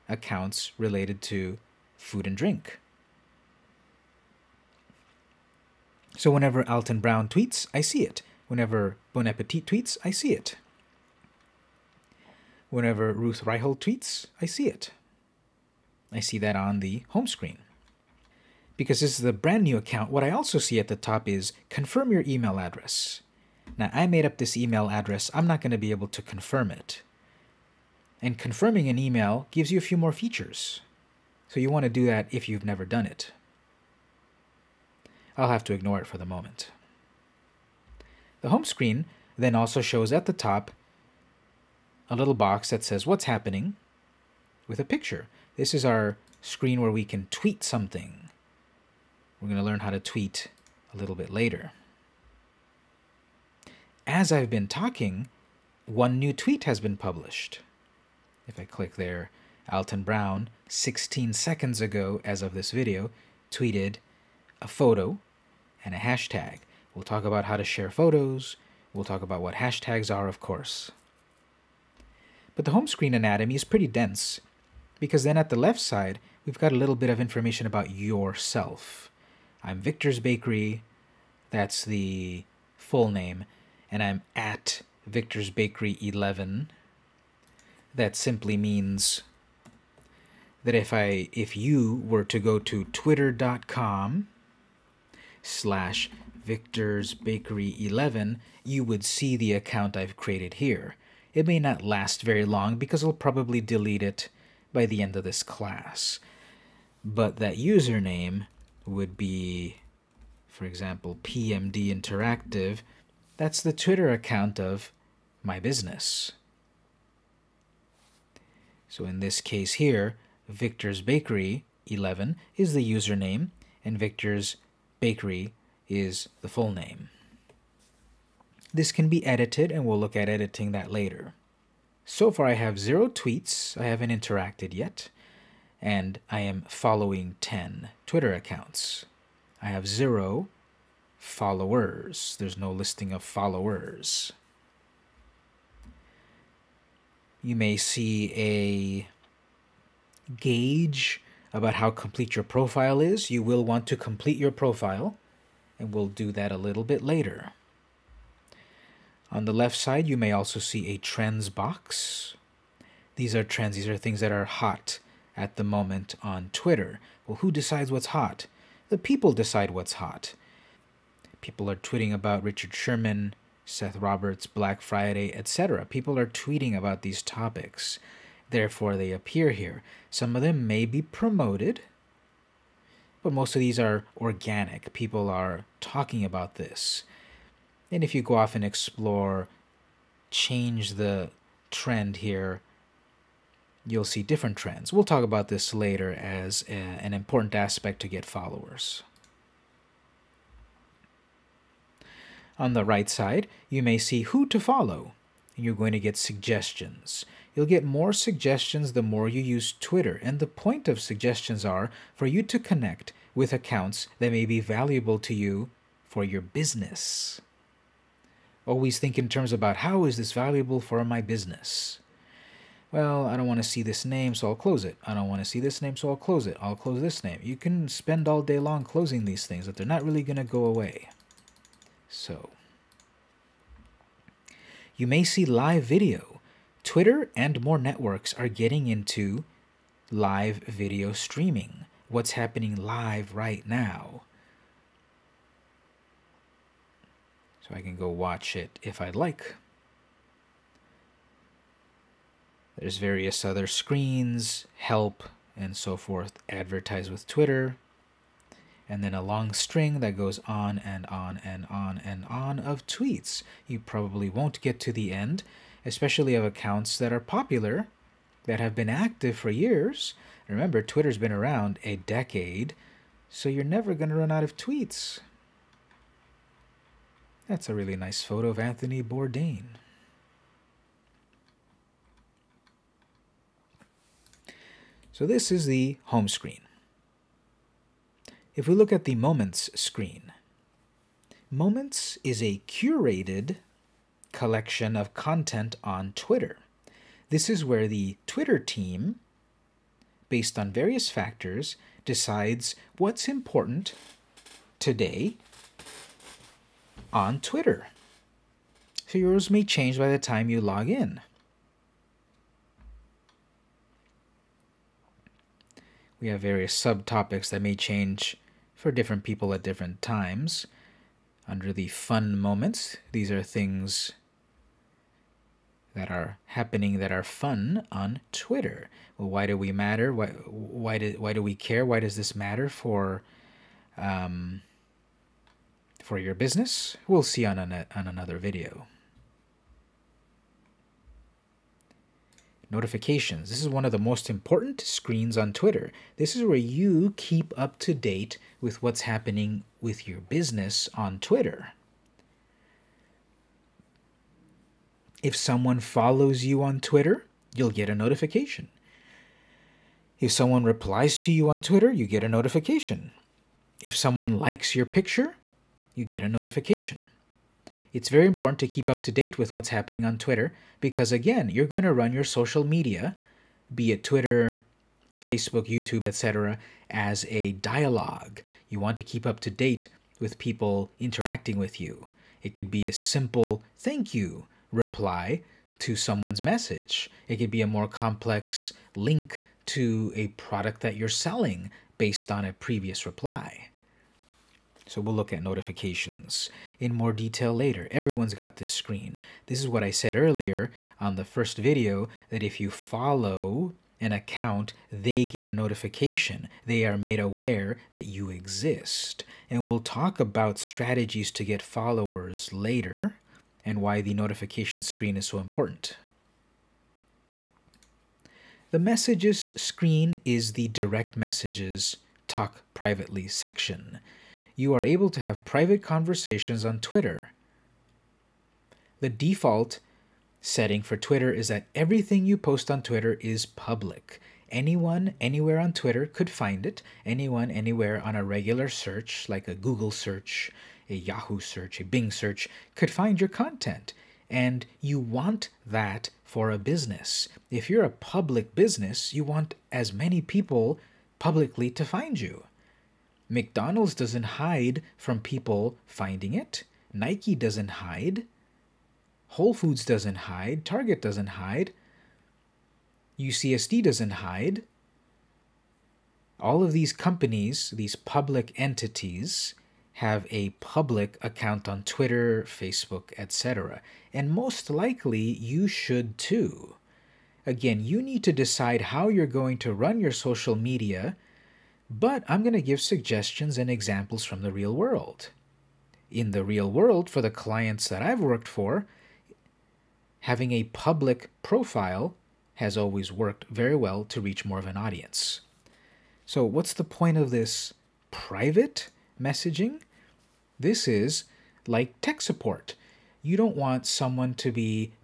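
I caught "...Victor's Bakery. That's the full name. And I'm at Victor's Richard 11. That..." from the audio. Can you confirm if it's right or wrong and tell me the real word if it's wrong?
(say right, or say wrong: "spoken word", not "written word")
wrong: "Bakery", not "Richard".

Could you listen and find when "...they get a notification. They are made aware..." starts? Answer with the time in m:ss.
6:44.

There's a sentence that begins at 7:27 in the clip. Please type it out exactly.
If you're a public business, you want as many people publicly to find you.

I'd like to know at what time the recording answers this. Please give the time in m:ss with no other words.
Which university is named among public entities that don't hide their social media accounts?
7:43.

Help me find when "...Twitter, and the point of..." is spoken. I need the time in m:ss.
3:29.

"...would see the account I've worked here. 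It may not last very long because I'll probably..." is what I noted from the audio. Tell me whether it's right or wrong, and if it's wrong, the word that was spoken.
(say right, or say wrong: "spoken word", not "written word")
wrong: "created", not "worked".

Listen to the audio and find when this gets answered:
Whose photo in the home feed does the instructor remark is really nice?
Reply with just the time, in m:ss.
4:38.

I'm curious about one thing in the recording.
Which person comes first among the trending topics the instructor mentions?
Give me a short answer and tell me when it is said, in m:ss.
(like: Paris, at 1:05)
Richard Sherman, at 2:52.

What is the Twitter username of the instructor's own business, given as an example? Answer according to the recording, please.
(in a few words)
PMD Interactive.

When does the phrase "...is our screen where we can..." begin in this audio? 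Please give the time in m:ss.
0:45.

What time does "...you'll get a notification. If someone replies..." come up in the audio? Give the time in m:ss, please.
5:57.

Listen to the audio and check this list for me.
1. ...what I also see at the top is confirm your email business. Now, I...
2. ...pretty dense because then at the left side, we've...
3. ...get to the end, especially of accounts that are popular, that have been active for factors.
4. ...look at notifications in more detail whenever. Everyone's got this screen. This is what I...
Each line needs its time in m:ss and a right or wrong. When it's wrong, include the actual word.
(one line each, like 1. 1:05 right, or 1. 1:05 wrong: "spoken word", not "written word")
1. 0:20 wrong: "address", not "business"
2. 1:13 right
3. 4:24 wrong: "years", not "factors"
4. 6:35 wrong: "later", not "whenever".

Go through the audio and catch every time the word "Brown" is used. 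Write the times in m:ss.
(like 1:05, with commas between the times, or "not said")
0:06, 1:00.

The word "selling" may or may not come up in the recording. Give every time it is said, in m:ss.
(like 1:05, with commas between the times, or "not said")
6:31.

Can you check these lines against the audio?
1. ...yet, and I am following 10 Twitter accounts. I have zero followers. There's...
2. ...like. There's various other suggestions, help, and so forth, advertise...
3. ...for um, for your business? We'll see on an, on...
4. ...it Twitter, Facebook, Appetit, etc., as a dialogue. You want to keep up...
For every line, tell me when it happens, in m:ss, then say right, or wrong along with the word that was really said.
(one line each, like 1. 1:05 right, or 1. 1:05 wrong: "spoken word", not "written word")
1. 2:14 right
2. 4:09 wrong: "screens", not "suggestions"
3. 5:32 right
4. 6:13 wrong: "YouTube", not "Appetit".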